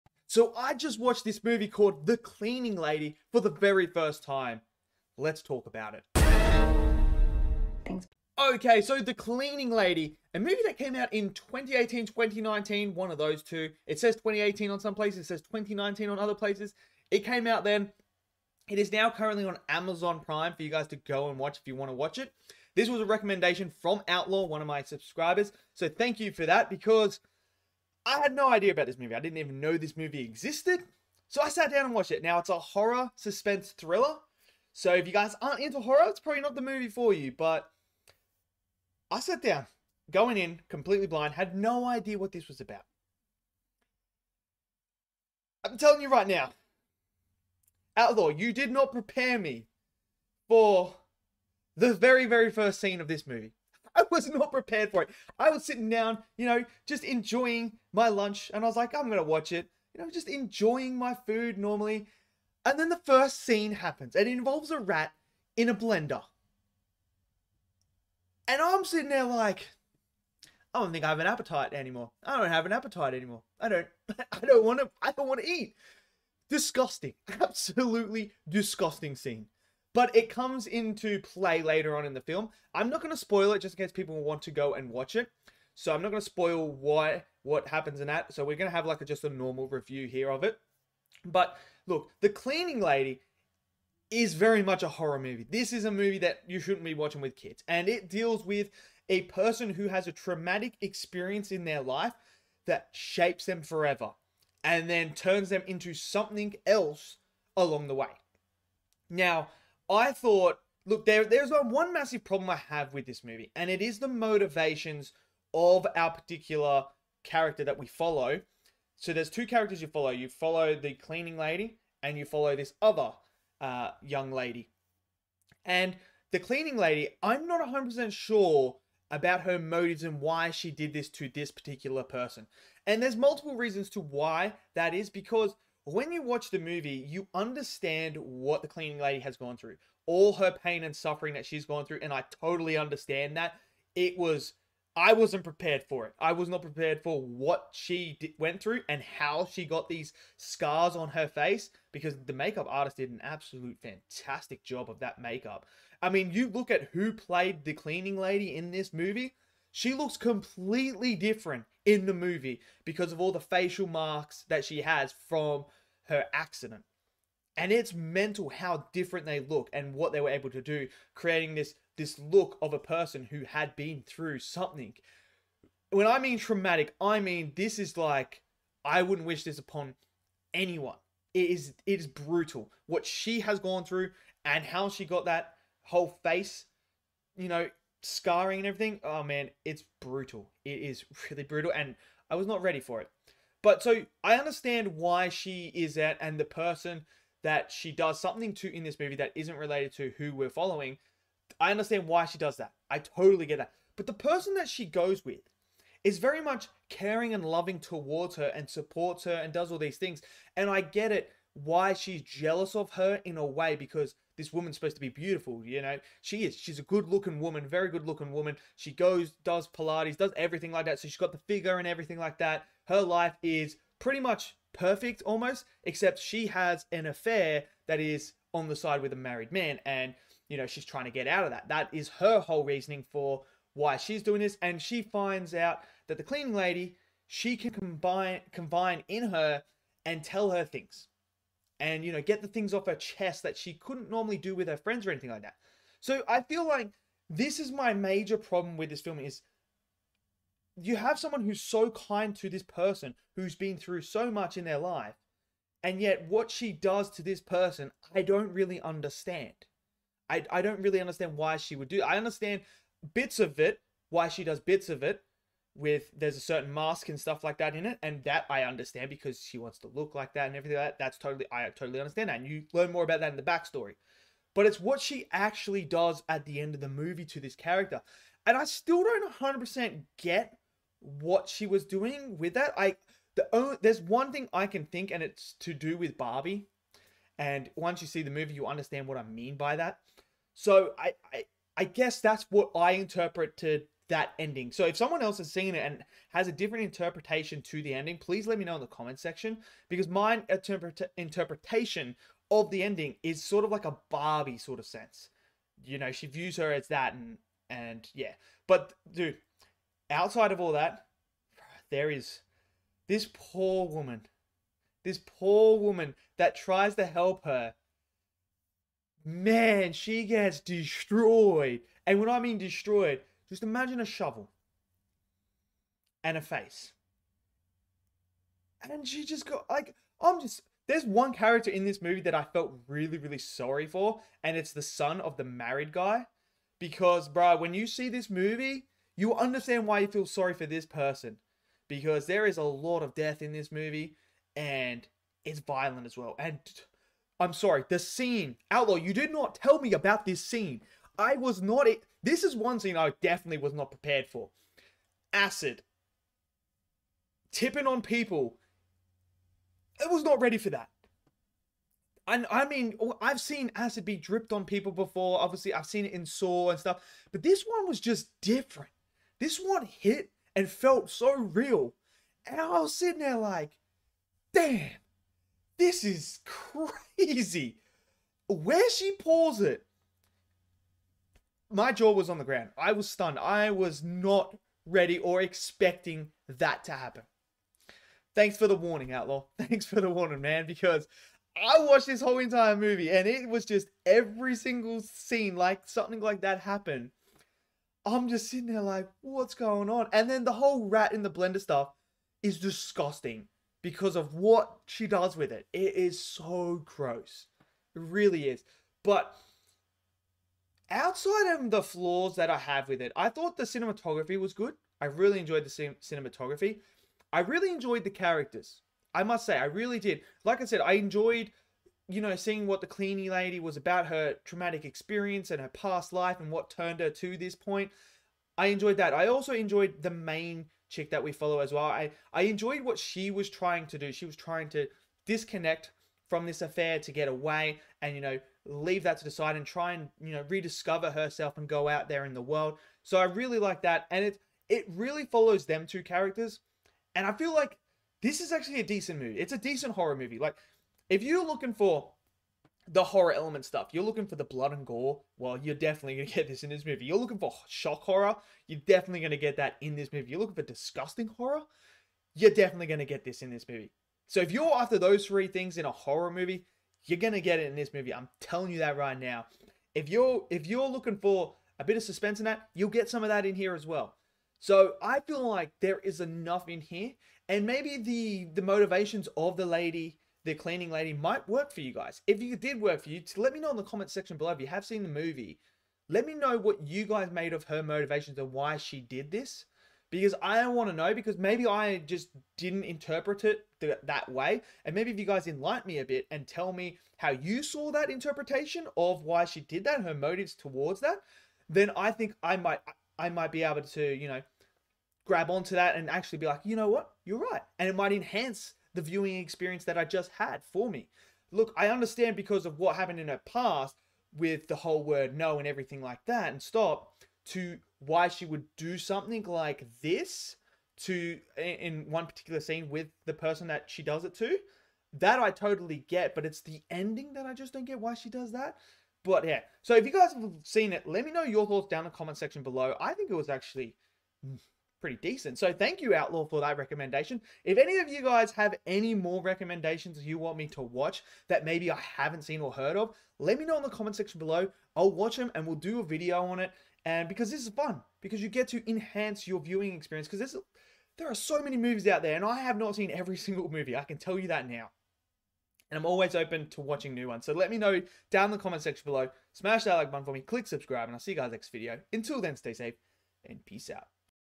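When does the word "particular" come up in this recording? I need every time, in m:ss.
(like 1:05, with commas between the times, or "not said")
1:56, 2:11, 8:42.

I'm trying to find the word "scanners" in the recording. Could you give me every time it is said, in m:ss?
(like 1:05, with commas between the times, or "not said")
not said.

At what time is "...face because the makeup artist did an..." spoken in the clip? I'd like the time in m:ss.
2:31.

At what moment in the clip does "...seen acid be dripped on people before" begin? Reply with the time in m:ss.
6:03.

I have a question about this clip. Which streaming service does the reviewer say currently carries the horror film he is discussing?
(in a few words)
Amazon Prime.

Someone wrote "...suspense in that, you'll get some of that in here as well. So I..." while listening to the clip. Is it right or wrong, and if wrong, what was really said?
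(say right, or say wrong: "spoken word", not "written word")
right.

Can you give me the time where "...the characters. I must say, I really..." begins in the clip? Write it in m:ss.
6:58.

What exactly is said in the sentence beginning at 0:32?
Now it's a horror suspense thriller.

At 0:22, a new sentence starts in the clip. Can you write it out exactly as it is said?
This was a recommendation from Outlaw, one of my subscribers.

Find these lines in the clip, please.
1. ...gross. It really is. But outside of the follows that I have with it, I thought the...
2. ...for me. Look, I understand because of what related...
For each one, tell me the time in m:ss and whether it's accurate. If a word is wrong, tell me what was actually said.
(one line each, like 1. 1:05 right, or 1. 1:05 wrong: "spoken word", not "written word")
1. 6:46 wrong: "flaws", not "follows"
2. 8:30 wrong: "happened", not "related".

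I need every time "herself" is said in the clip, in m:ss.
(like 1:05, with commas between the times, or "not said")
7:21.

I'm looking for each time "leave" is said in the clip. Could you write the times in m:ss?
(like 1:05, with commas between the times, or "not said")
7:18.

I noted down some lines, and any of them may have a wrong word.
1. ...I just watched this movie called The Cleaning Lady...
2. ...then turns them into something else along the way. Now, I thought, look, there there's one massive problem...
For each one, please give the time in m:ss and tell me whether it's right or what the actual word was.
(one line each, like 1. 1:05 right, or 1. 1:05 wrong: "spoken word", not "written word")
1. 0:00 right
2. 1:44 right.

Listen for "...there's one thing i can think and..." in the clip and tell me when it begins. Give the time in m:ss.
4:43.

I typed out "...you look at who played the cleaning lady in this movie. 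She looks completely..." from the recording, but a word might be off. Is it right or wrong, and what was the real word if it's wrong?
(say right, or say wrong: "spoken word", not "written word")
right.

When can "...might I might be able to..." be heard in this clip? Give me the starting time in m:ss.
8:22.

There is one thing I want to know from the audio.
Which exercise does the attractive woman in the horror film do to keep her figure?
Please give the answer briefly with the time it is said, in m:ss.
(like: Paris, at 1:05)
Pilates, at 3:39.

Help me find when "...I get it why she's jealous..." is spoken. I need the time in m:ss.
3:30.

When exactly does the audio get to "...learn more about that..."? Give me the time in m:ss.
4:32.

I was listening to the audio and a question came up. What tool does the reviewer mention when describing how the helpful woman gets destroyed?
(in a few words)
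A shovel.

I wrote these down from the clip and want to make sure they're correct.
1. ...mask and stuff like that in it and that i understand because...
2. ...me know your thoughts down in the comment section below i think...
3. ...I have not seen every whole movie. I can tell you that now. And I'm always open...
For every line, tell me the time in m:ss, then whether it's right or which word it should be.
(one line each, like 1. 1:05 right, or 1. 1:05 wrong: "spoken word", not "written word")
1. 4:26 right
2. 8:51 right
3. 9:12 wrong: "single", not "whole".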